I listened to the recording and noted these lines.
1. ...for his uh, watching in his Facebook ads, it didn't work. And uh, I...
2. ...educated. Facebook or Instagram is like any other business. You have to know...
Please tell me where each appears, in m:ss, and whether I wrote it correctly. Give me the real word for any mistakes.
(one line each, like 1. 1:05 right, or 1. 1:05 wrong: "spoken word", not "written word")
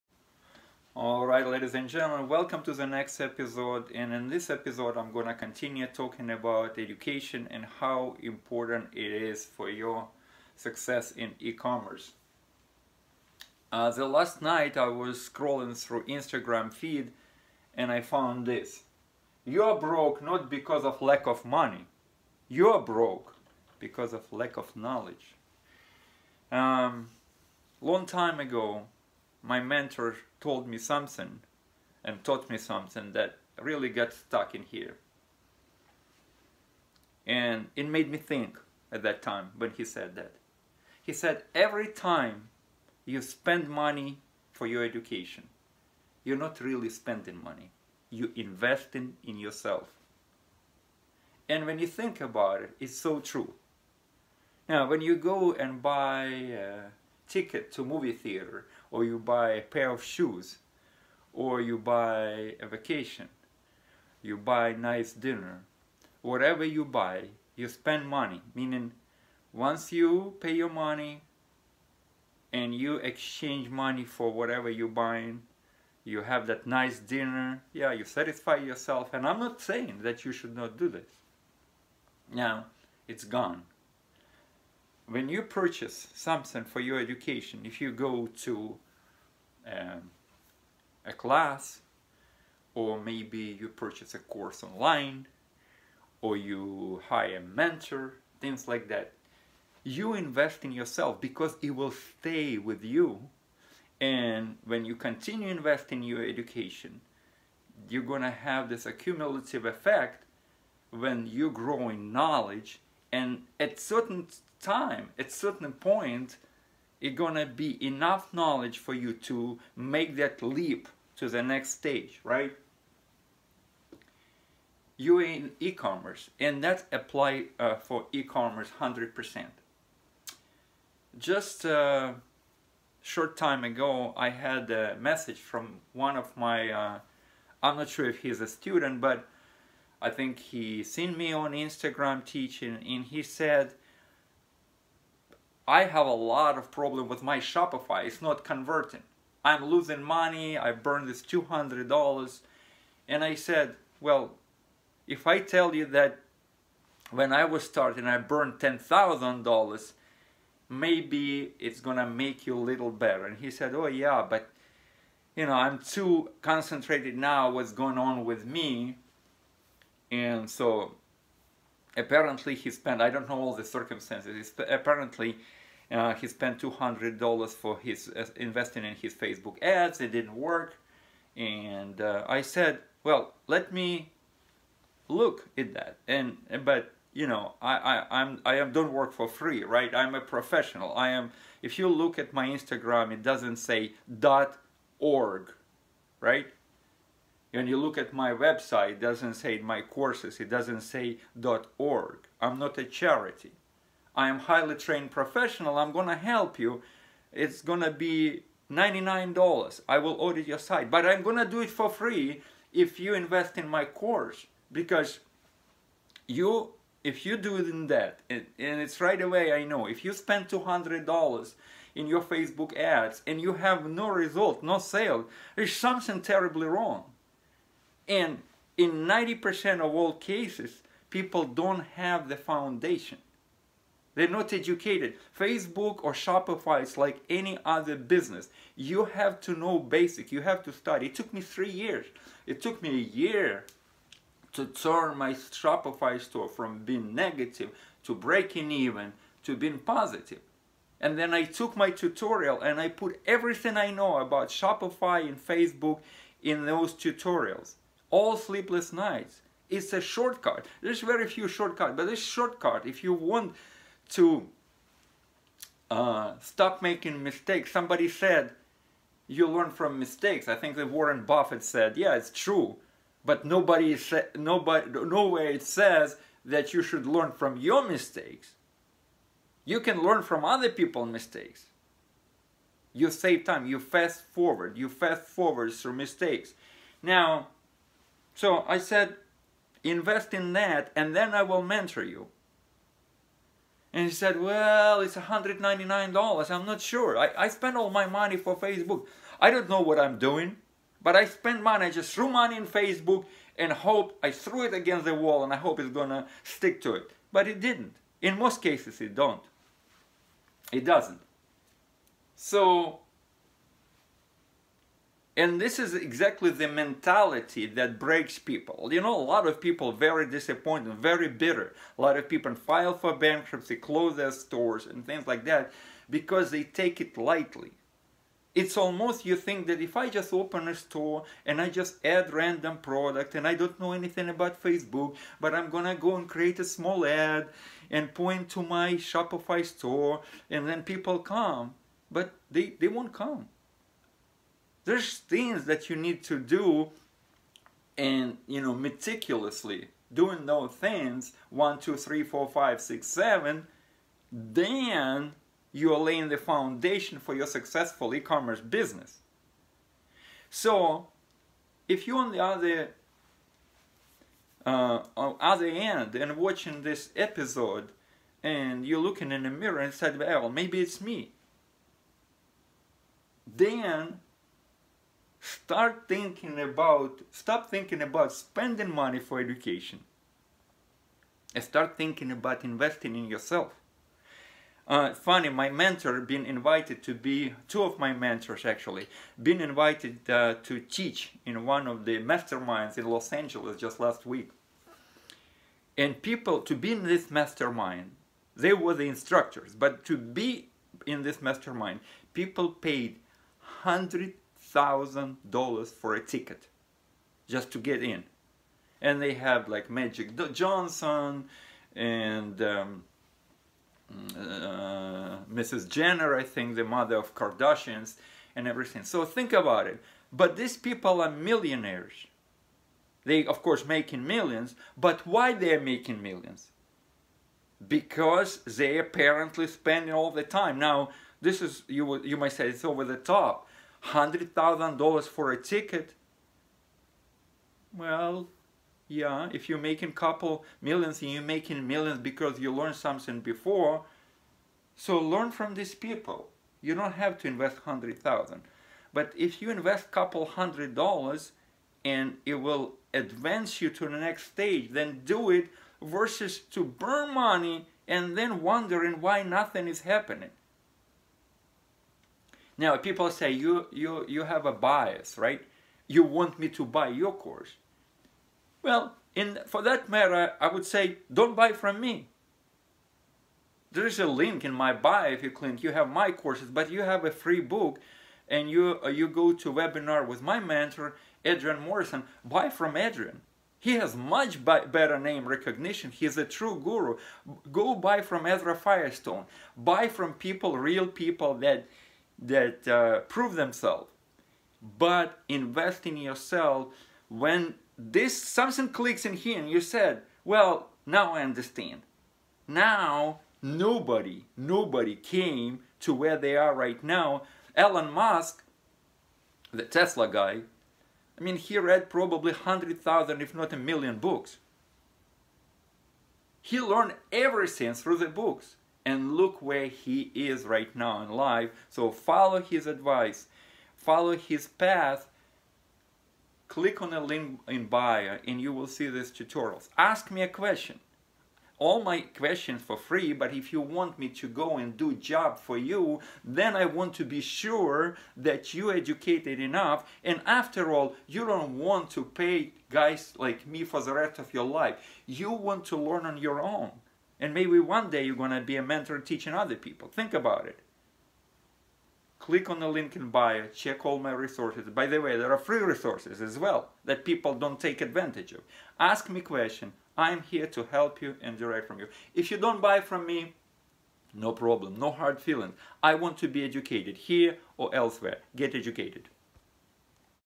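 1. 2:57 wrong: "investing", not "watching"
2. 3:54 wrong: "Shopify", not "Instagram".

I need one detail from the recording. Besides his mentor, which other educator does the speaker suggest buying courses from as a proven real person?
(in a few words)
Ezra Firestone.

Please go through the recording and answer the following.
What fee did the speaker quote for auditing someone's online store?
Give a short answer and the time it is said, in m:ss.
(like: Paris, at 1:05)
$99, at 3:27.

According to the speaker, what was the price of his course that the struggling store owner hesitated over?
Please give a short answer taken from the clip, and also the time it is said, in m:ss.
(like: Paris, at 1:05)
$199, at 4:55.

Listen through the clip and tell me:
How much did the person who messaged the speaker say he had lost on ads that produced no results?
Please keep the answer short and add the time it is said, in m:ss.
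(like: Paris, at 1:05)
$200, at 2:30.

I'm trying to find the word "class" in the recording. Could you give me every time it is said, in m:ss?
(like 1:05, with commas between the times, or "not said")
1:31.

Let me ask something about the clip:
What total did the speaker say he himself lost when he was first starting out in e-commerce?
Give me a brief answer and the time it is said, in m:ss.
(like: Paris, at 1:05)
$10,000, at 2:38.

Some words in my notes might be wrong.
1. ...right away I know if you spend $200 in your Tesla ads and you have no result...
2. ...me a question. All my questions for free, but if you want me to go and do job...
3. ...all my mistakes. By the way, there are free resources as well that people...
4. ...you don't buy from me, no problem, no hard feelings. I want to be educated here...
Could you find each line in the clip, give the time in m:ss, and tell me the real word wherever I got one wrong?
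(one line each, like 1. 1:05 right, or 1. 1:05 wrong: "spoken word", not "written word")
1. 3:39 wrong: "Facebook", not "Tesla"
2. 8:50 right
3. 9:14 wrong: "resources", not "mistakes"
4. 9:22 right.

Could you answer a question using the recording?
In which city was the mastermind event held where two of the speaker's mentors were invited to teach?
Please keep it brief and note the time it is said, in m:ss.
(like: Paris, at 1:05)
Los Angeles, at 6:33.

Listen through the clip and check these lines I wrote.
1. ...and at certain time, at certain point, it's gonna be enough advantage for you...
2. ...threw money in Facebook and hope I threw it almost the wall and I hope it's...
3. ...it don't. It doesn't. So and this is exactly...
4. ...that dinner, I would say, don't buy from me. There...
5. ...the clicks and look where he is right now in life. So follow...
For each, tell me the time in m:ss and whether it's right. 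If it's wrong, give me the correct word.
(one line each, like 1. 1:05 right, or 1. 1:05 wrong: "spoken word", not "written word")
1. 1:53 wrong: "knowledge", not "advantage"
2. 5:02 wrong: "against", not "almost"
3. 5:09 right
4. 7:49 wrong: "matter", not "dinner"
5. 8:38 wrong: "books", not "clicks".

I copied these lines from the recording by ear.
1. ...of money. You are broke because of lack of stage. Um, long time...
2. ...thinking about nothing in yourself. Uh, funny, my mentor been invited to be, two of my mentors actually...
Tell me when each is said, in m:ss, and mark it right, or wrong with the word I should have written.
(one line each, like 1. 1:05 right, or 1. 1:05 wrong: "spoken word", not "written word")
1. 0:21 wrong: "knowledge", not "stage"
2. 6:21 wrong: "investing", not "nothing".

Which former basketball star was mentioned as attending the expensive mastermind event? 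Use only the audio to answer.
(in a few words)
Magic Johnson.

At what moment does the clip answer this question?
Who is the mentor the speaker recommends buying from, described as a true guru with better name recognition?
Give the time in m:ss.
8:01.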